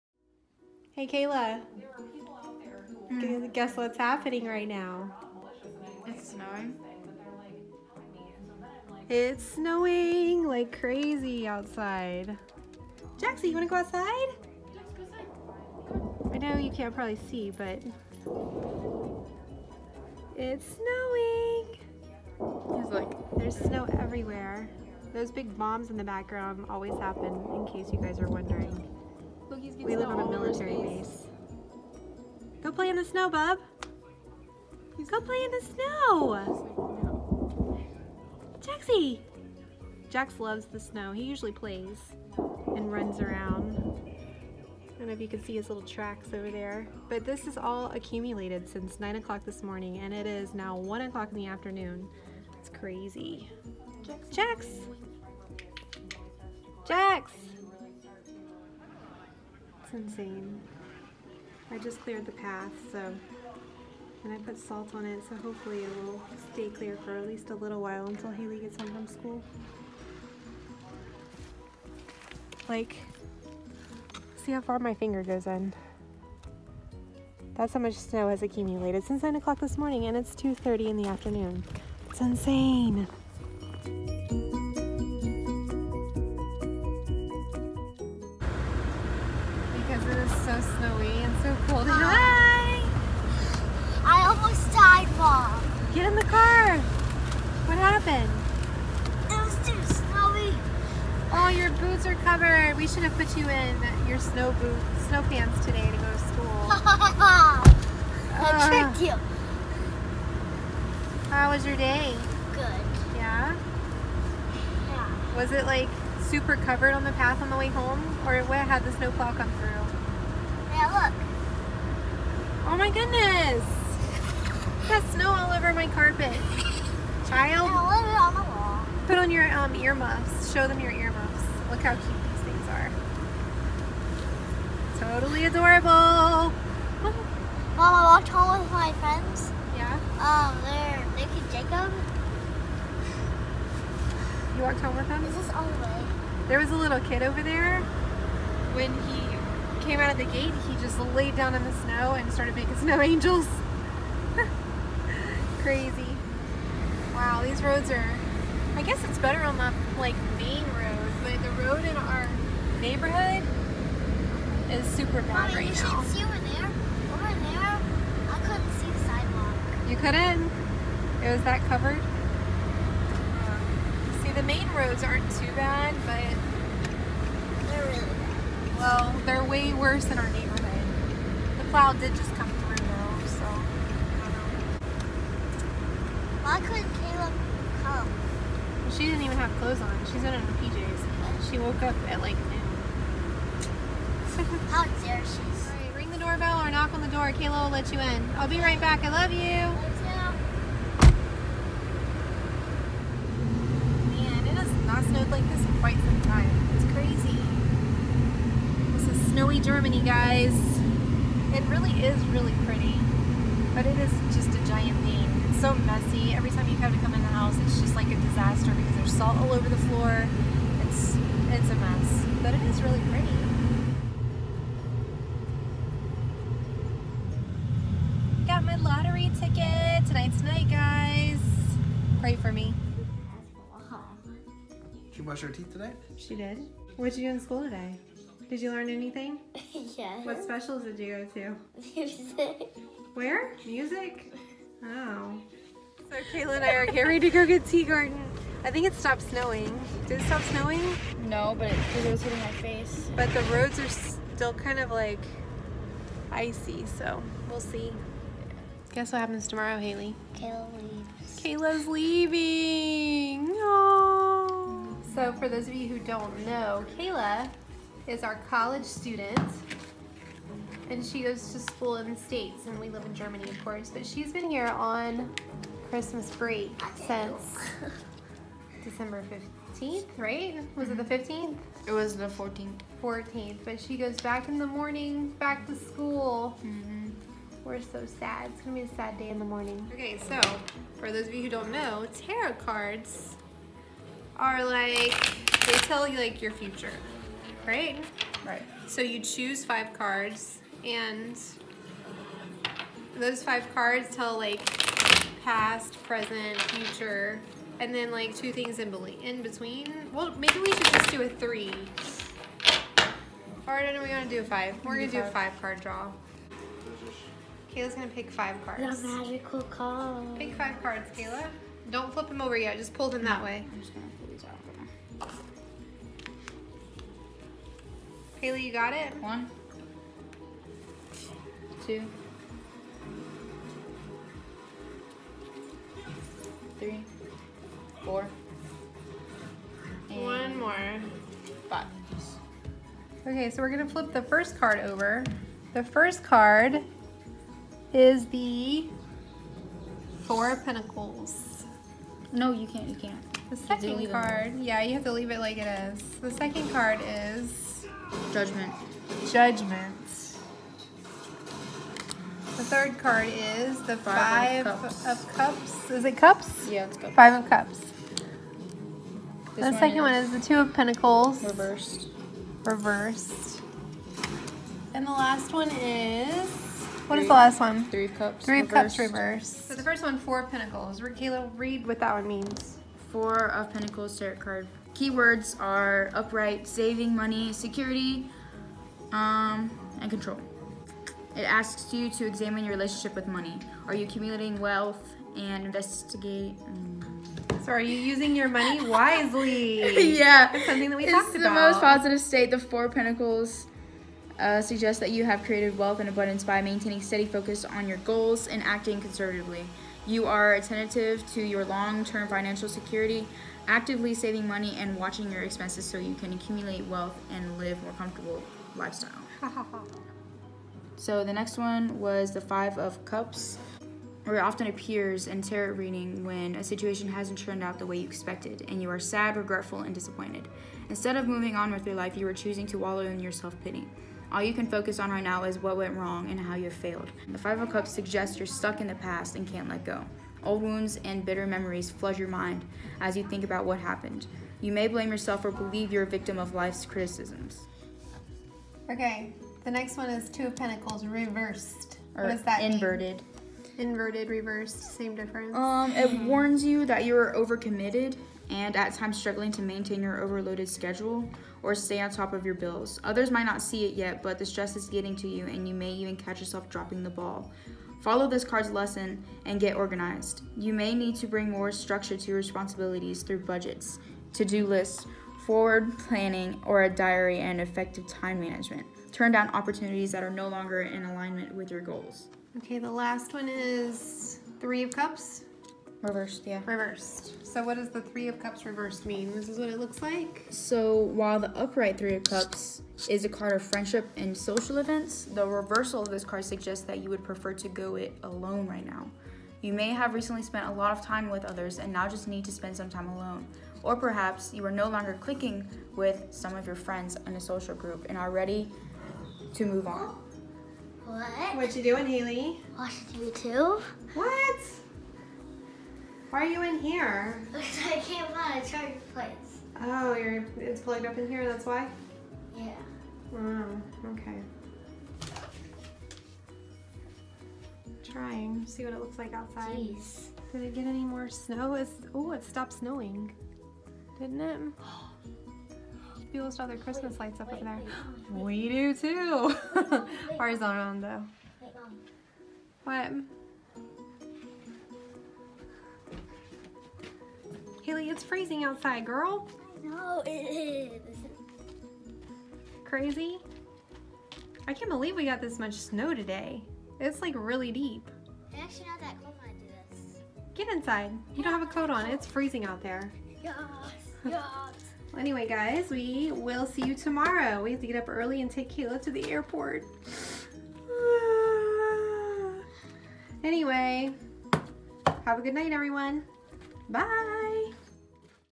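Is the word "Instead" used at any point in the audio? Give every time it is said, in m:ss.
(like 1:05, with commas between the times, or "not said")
7:10.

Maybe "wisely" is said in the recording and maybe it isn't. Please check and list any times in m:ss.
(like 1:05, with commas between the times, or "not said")
6:38.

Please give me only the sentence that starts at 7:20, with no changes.
Old wounds and bitter memories flood your mind as you think about what happened.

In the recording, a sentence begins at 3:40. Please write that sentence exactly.
It's, it's a mess, but it is really pretty.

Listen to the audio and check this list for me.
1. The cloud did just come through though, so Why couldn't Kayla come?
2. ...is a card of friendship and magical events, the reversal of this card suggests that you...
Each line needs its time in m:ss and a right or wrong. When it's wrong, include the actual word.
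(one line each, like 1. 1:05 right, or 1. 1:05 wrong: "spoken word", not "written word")
1. 3:01 right
2. 8:13 wrong: "social", not "magical".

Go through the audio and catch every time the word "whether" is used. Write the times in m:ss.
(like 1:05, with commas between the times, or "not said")
not said.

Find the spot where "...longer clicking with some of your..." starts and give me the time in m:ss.
8:24.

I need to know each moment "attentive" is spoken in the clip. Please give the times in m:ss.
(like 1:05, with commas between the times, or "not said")
6:50.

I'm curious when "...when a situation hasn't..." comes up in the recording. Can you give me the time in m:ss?
7:06.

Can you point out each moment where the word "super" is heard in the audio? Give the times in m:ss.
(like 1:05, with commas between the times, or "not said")
1:56, 2:44.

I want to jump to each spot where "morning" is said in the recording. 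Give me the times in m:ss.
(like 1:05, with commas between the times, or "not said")
0:49, 1:19, 4:44, 4:49.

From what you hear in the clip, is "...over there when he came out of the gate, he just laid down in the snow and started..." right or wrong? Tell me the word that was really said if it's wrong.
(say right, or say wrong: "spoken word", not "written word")
right.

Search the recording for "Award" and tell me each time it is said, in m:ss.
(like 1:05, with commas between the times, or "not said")
not said.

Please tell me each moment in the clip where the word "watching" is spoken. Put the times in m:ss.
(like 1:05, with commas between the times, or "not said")
6:54, 8:32.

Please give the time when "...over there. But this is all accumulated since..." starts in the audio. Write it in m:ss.
0:46.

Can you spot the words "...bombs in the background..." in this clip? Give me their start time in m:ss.
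0:25.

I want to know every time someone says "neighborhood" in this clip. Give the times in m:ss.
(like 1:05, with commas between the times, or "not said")
2:42, 3:00.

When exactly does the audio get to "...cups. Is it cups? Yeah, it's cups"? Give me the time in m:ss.
6:05.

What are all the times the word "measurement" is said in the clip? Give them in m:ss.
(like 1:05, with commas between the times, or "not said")
not said.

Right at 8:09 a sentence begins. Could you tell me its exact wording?
This is what it looks like?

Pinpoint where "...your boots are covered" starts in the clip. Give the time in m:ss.
1:41.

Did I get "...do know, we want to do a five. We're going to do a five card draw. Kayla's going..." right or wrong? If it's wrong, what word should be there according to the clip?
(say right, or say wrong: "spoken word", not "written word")
right.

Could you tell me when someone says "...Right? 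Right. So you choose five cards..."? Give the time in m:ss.
4:57.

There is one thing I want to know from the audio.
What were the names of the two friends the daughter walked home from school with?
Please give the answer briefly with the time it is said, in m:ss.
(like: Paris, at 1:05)
Nick and Jacob, at 2:21.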